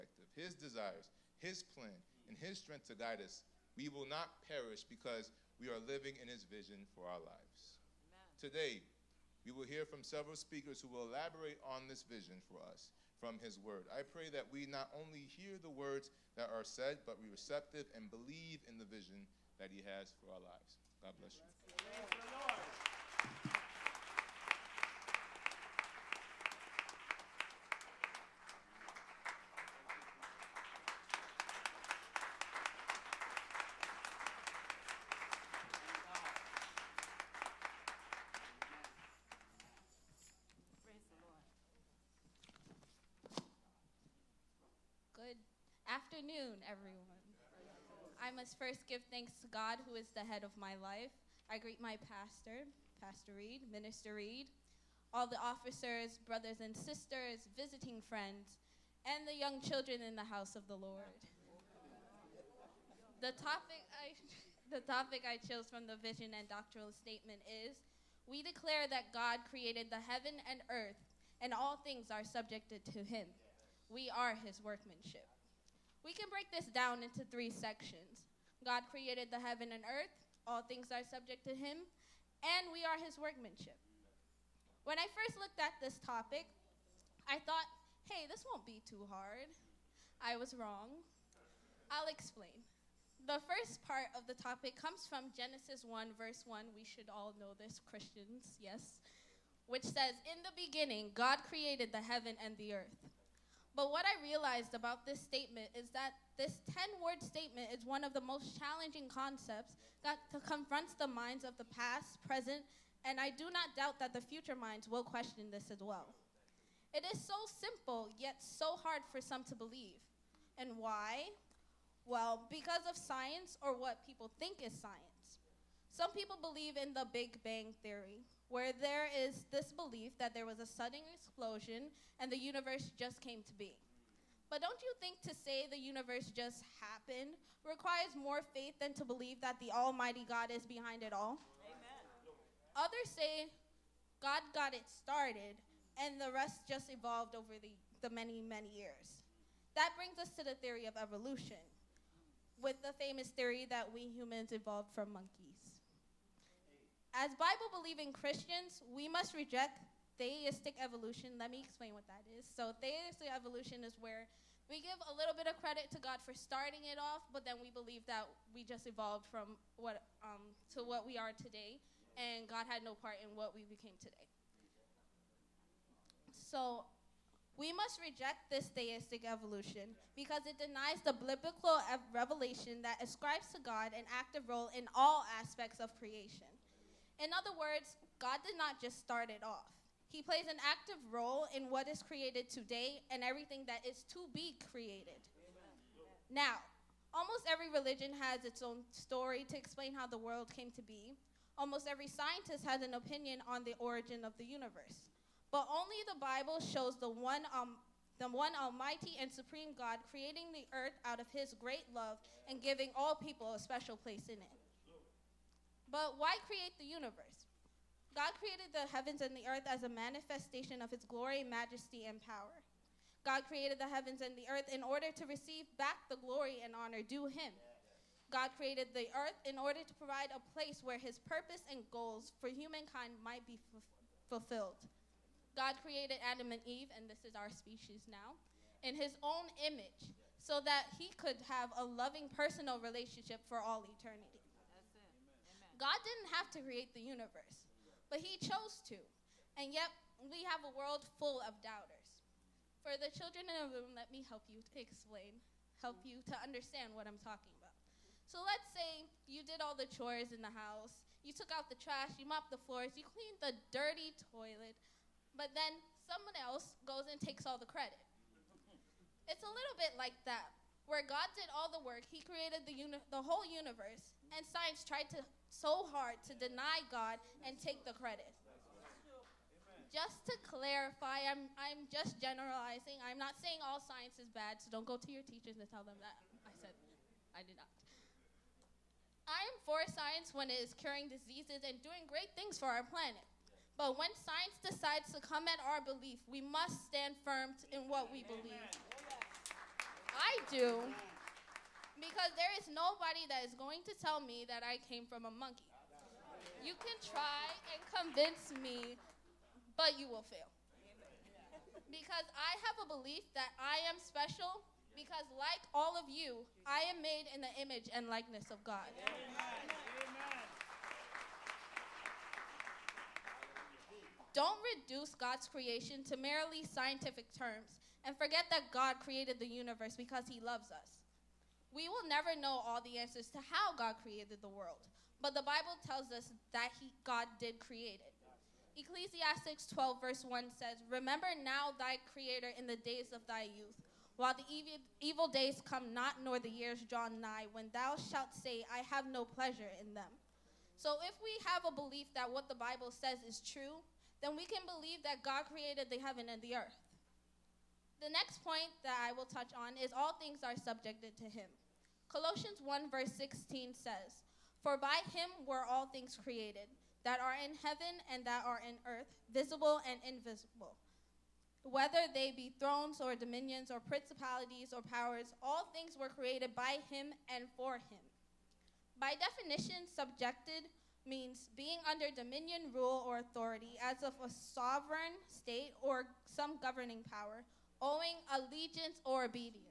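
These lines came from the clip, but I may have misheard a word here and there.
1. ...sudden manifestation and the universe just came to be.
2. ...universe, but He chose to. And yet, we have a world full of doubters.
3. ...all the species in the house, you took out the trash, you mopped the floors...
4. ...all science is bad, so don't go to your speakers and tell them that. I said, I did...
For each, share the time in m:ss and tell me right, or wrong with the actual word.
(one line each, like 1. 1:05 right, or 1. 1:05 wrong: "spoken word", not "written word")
1. 2:10 wrong: "explosion", not "manifestation"
2. 4:07 right
3. 4:19 wrong: "chores", not "species"
4. 4:43 wrong: "teachers", not "speakers".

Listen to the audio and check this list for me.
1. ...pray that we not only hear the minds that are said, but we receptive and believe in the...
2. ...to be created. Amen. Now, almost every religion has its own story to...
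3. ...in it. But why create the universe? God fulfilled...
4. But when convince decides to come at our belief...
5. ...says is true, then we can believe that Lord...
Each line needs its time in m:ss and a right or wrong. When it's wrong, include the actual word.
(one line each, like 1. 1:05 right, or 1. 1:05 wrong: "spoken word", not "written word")
1. 0:14 wrong: "words", not "minds"
2. 3:14 right
3. 3:34 wrong: "created", not "fulfilled"
4. 4:53 wrong: "science", not "convince"
5. 5:52 wrong: "God", not "Lord".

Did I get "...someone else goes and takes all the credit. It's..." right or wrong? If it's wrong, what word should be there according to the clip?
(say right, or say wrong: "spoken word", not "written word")
right.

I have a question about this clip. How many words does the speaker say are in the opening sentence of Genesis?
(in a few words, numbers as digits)
10.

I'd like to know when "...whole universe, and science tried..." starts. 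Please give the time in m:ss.
4:33.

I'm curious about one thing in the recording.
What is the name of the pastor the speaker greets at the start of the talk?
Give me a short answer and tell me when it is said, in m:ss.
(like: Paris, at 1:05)
Pastor Reid, at 0:53.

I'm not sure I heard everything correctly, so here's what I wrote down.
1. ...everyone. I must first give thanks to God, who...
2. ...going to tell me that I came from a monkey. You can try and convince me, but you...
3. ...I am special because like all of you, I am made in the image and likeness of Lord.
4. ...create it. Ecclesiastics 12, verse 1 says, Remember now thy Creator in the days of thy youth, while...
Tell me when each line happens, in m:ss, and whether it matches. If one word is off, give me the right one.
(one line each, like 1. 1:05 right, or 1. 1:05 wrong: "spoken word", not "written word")
1. 0:46 right
2. 5:03 right
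3. 5:13 wrong: "God", not "Lord"
4. 5:37 right.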